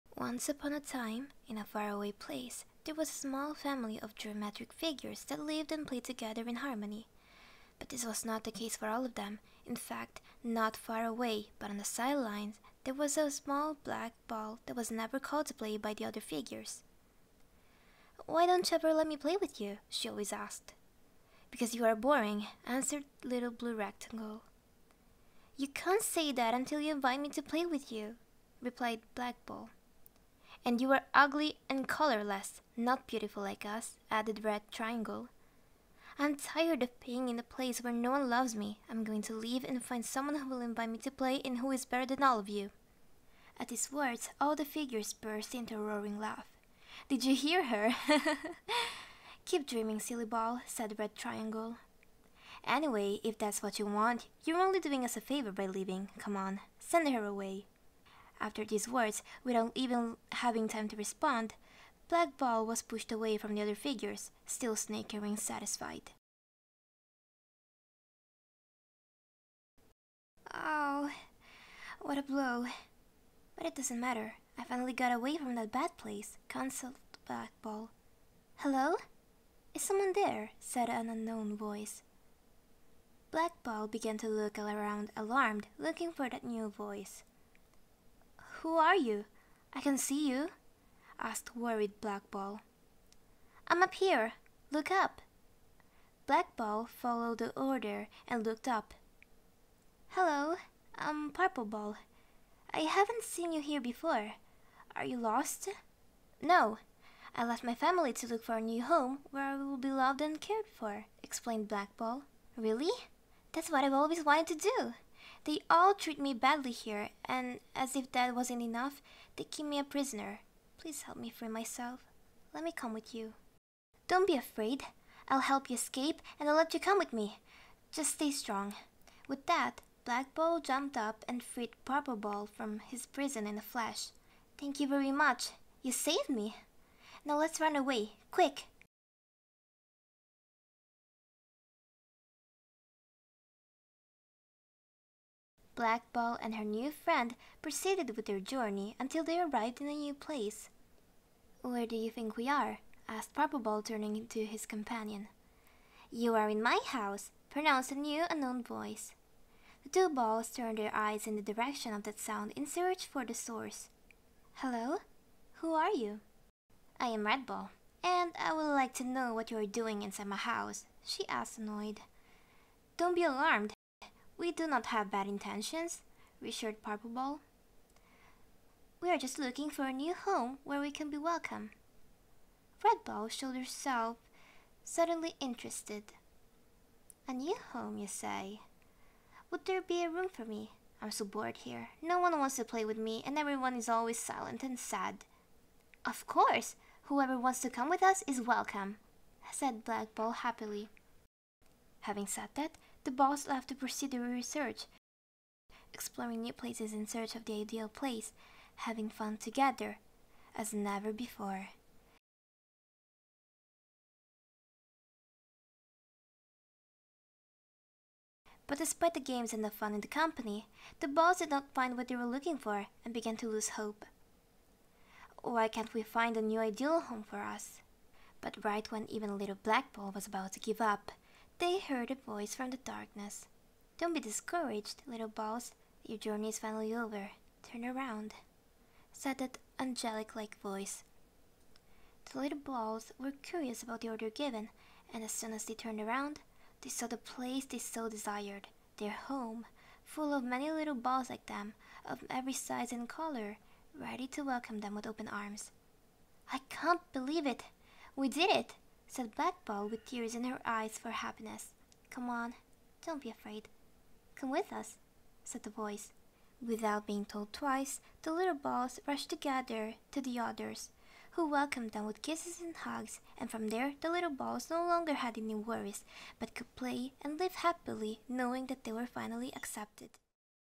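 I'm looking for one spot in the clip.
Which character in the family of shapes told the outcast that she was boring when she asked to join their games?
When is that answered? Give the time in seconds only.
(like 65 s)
23 s.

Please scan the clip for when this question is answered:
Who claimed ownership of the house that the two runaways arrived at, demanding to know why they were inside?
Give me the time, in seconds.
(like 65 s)
167 s.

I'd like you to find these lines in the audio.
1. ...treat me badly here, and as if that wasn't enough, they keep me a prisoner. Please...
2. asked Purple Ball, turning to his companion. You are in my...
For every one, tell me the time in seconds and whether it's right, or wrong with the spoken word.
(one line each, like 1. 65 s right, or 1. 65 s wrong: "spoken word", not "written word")
1. 115 s right
2. 153 s right.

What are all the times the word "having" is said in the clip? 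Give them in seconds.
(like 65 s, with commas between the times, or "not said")
60 s, 202 s, 208 s.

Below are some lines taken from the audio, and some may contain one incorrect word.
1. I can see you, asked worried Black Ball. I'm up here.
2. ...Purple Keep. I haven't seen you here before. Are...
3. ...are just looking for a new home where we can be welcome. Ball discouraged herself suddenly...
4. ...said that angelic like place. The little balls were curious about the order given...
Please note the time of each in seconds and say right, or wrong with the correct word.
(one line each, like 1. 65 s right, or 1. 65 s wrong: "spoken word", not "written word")
1. 89 s right
2. 101 s wrong: "Ball", not "Keep"
3. 179 s wrong: "showed", not "discouraged"
4. 239 s wrong: "voice", not "place".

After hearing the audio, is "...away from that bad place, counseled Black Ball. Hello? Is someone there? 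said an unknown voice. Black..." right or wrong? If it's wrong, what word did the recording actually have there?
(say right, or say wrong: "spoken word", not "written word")
right.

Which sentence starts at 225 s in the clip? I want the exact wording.
Why can't we find a new ideal home for us?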